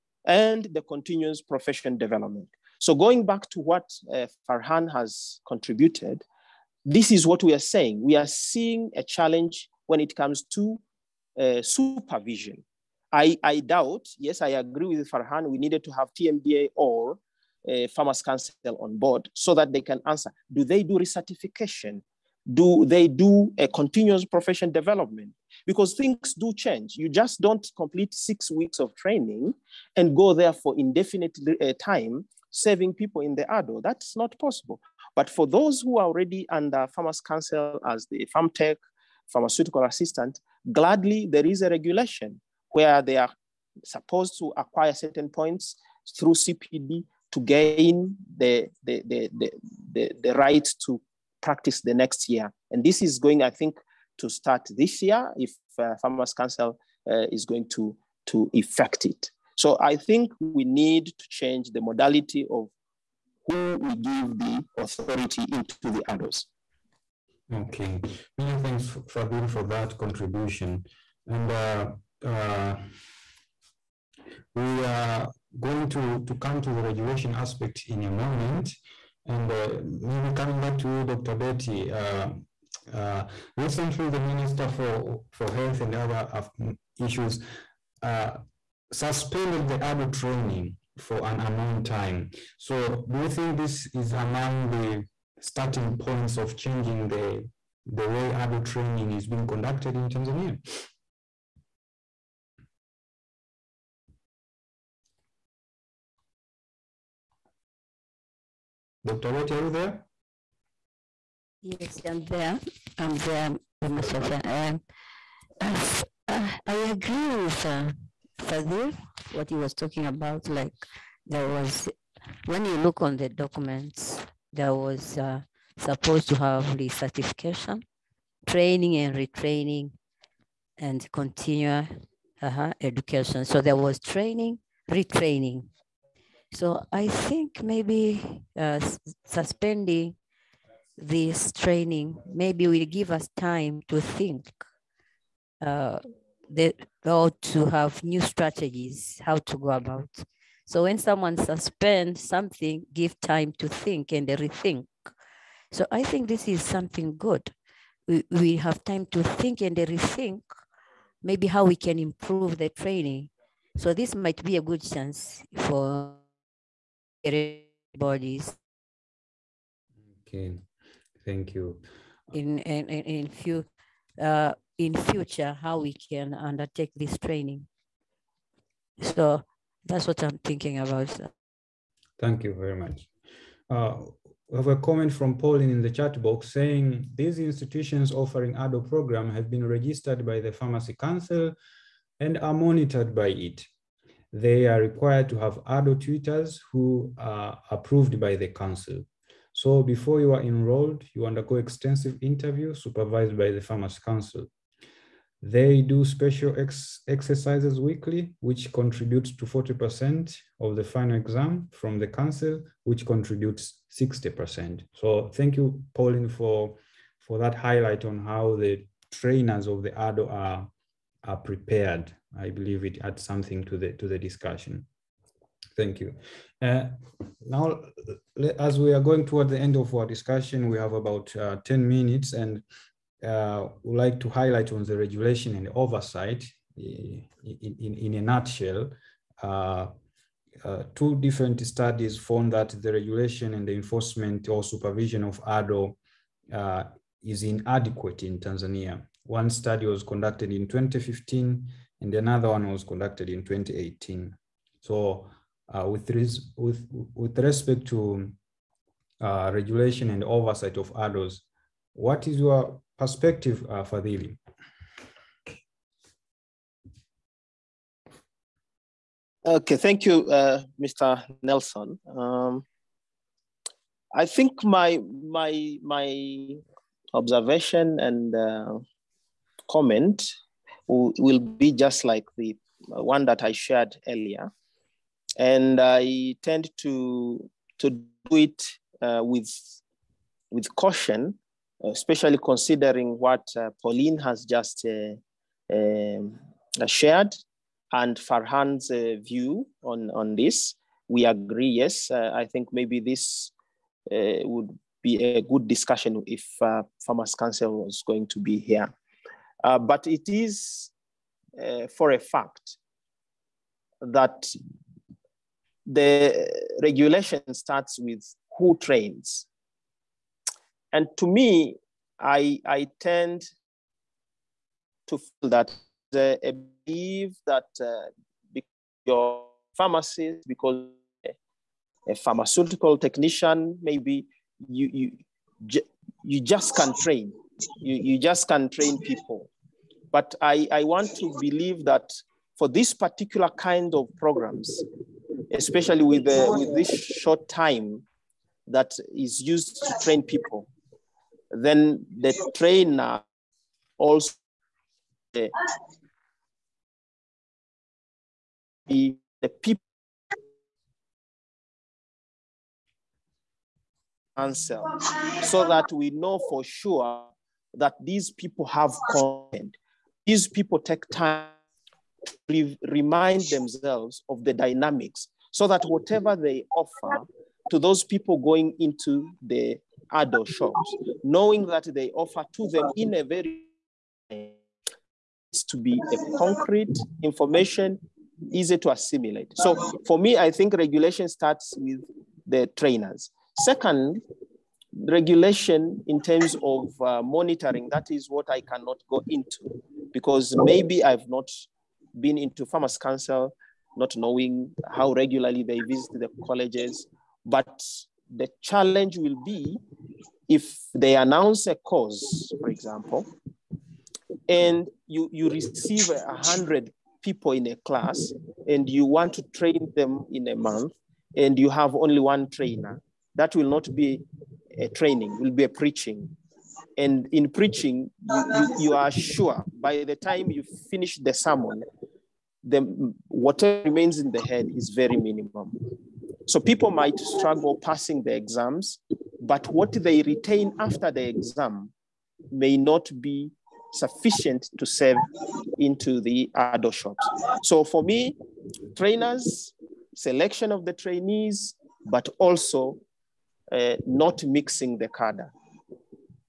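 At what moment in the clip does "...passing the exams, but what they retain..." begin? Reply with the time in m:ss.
7:17.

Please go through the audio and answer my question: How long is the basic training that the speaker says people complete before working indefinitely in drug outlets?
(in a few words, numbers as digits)
6 weeks.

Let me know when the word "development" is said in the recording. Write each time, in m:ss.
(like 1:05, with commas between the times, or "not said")
0:01, 0:24.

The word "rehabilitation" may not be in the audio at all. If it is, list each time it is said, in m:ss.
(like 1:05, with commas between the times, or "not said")
not said.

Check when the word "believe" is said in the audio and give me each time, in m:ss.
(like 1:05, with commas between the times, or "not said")
3:42, 5:26, 5:41.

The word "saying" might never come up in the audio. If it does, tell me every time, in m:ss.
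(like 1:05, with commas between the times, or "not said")
0:07, 3:06.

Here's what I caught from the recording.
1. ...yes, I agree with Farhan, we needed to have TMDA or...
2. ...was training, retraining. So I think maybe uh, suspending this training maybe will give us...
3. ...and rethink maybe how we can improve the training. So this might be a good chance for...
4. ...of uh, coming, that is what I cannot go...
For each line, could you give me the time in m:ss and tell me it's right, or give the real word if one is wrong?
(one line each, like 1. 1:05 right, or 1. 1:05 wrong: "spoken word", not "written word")
1. 0:14 right
2. 2:13 right
3. 2:39 right
4. 6:36 wrong: "monitoring", not "coming".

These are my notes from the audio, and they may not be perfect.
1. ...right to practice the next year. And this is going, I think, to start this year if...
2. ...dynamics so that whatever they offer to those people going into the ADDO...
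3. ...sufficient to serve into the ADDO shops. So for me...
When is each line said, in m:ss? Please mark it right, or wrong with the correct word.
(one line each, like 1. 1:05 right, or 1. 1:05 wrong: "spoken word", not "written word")
1. 0:50 right
2. 6:14 right
3. 7:23 right.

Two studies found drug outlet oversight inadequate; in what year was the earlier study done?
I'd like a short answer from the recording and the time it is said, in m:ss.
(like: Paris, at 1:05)
2015, at 4:10.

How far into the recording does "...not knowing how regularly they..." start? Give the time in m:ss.
6:43.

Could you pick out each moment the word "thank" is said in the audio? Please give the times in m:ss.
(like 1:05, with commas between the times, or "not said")
1:08, 2:51, 3:02, 3:35, 3:45, 4:29.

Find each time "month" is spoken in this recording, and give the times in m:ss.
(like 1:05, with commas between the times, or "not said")
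7:00.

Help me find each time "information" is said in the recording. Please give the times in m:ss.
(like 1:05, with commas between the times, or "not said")
6:27.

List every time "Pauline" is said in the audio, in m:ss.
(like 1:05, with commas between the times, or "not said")
3:05, 3:35, 4:53.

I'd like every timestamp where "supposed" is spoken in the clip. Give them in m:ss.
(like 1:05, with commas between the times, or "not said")
0:43, 2:05.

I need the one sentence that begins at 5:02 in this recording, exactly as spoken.
Uh, I think maybe this would be a good discussion if Pharmacy Council was going to be here.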